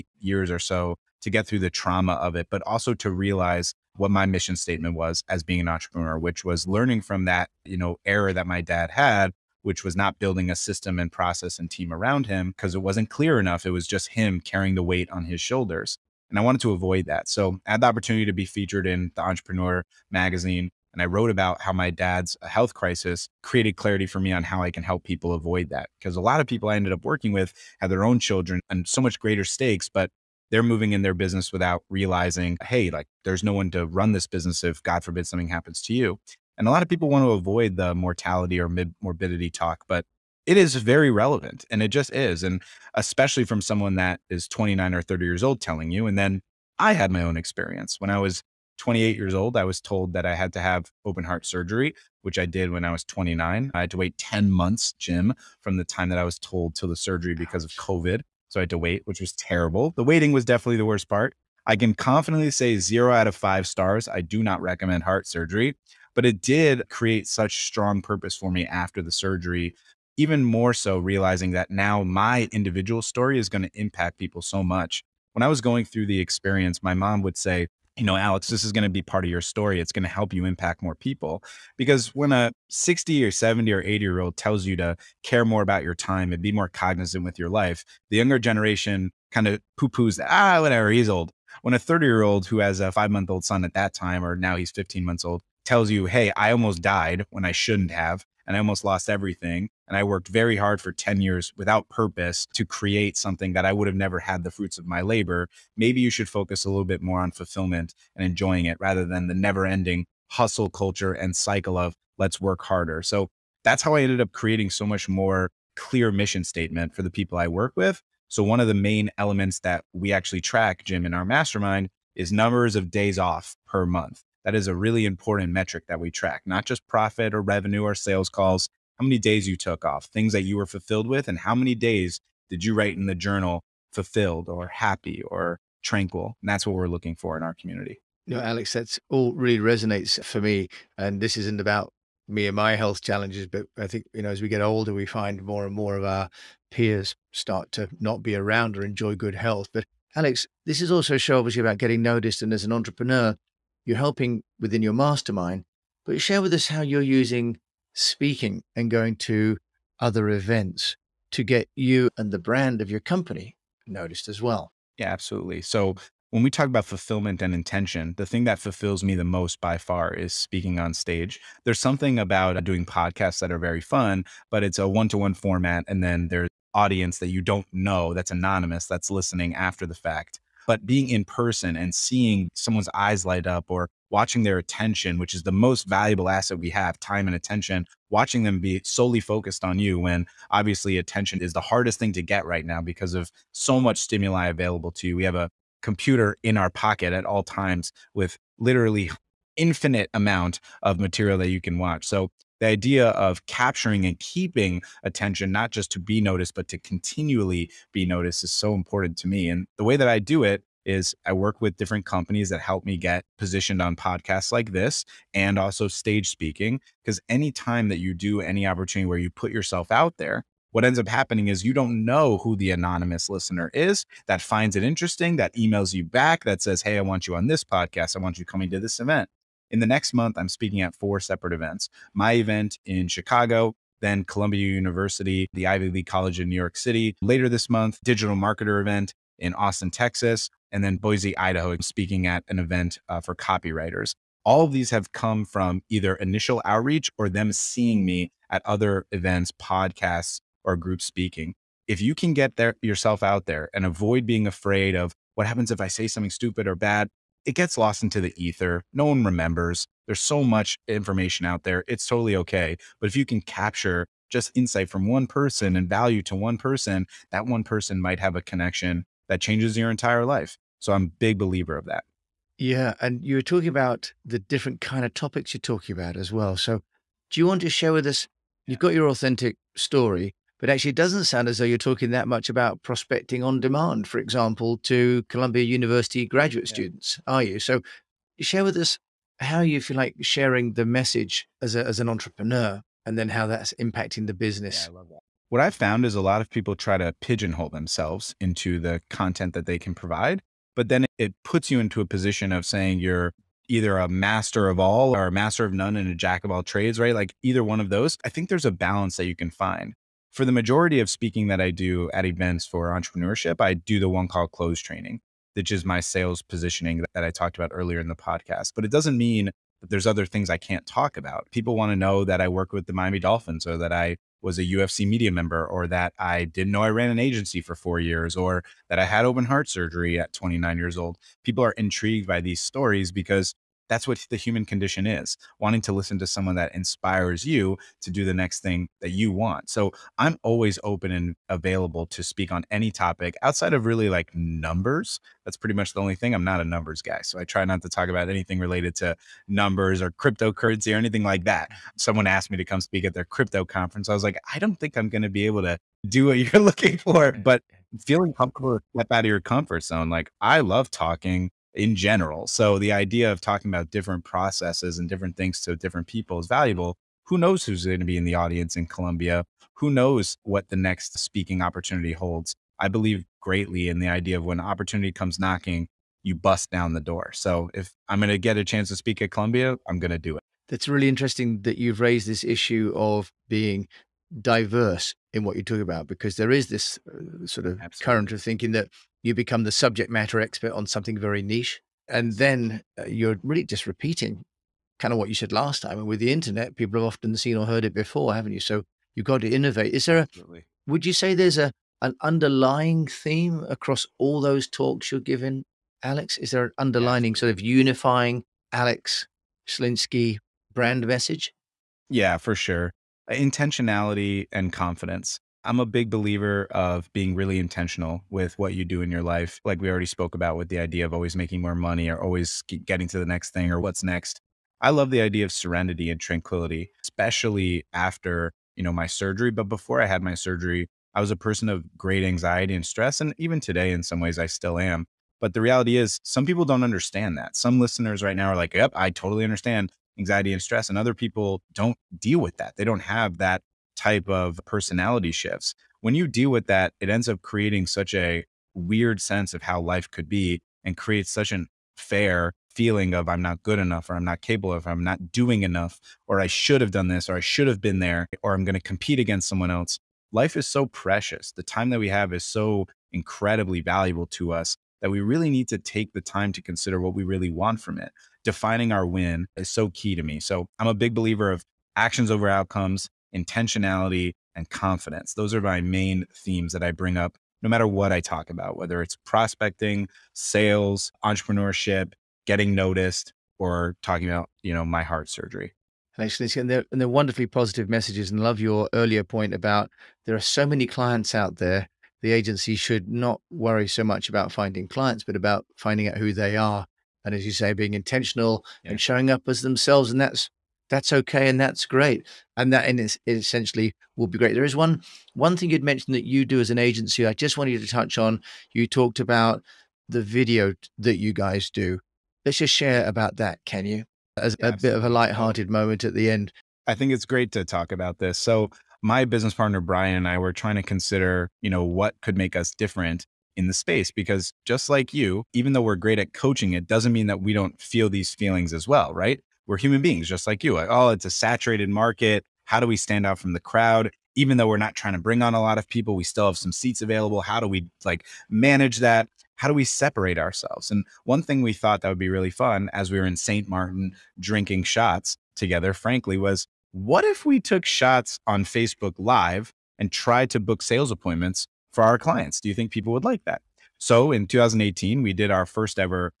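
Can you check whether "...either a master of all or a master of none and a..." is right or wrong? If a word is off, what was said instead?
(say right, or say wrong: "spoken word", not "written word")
right.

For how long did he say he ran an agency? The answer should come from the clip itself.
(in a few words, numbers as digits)
4 years.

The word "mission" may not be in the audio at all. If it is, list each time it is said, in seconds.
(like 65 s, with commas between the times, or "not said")
4 s, 116 s.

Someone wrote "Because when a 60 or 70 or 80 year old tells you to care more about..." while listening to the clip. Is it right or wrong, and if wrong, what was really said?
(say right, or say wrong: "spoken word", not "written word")
right.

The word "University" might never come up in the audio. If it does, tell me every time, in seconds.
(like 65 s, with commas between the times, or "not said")
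234 s, 285 s.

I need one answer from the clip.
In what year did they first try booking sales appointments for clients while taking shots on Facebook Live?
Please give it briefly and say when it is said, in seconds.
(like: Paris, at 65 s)
2018, at 554 s.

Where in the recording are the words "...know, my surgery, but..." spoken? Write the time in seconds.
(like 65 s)
428 s.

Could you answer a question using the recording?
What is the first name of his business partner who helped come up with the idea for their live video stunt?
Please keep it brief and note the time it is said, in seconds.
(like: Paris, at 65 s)
Brian, at 519 s.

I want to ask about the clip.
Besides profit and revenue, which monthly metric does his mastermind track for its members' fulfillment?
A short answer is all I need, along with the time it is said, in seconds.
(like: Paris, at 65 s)
Days off per month, at 122 s.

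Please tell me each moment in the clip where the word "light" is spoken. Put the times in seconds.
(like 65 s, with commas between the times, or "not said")
183 s, 515 s.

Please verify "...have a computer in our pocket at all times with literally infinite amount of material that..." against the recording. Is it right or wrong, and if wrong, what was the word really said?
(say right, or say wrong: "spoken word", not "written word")
right.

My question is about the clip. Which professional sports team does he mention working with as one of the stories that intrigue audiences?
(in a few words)
Miami Dolphins.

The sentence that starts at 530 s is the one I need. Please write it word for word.
Like, oh, it's a saturated market.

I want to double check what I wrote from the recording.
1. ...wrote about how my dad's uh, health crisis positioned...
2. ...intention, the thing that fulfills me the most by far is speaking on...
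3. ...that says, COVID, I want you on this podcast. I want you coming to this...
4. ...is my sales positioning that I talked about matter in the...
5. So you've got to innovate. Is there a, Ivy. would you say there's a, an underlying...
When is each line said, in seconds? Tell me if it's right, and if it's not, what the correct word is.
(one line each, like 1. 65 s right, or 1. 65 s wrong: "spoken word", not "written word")
1. 21 s wrong: "created", not "positioned"
2. 167 s right
3. 226 s wrong: "Hey", not "COVID"
4. 315 s wrong: "earlier", not "matter"
5. 398 s wrong: "Absolutely", not "Ivy".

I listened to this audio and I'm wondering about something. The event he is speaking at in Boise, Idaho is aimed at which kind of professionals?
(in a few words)
Copywriters.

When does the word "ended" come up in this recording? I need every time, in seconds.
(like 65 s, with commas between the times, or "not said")
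26 s, 114 s.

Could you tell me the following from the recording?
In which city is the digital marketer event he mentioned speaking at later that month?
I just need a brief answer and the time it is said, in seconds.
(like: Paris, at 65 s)
Austin, Texas, at 239 s.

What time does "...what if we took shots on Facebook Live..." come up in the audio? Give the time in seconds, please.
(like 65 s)
546 s.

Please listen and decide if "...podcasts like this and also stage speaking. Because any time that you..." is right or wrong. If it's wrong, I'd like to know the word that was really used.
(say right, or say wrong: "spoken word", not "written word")
right.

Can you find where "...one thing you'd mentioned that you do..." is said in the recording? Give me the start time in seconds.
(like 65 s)
505 s.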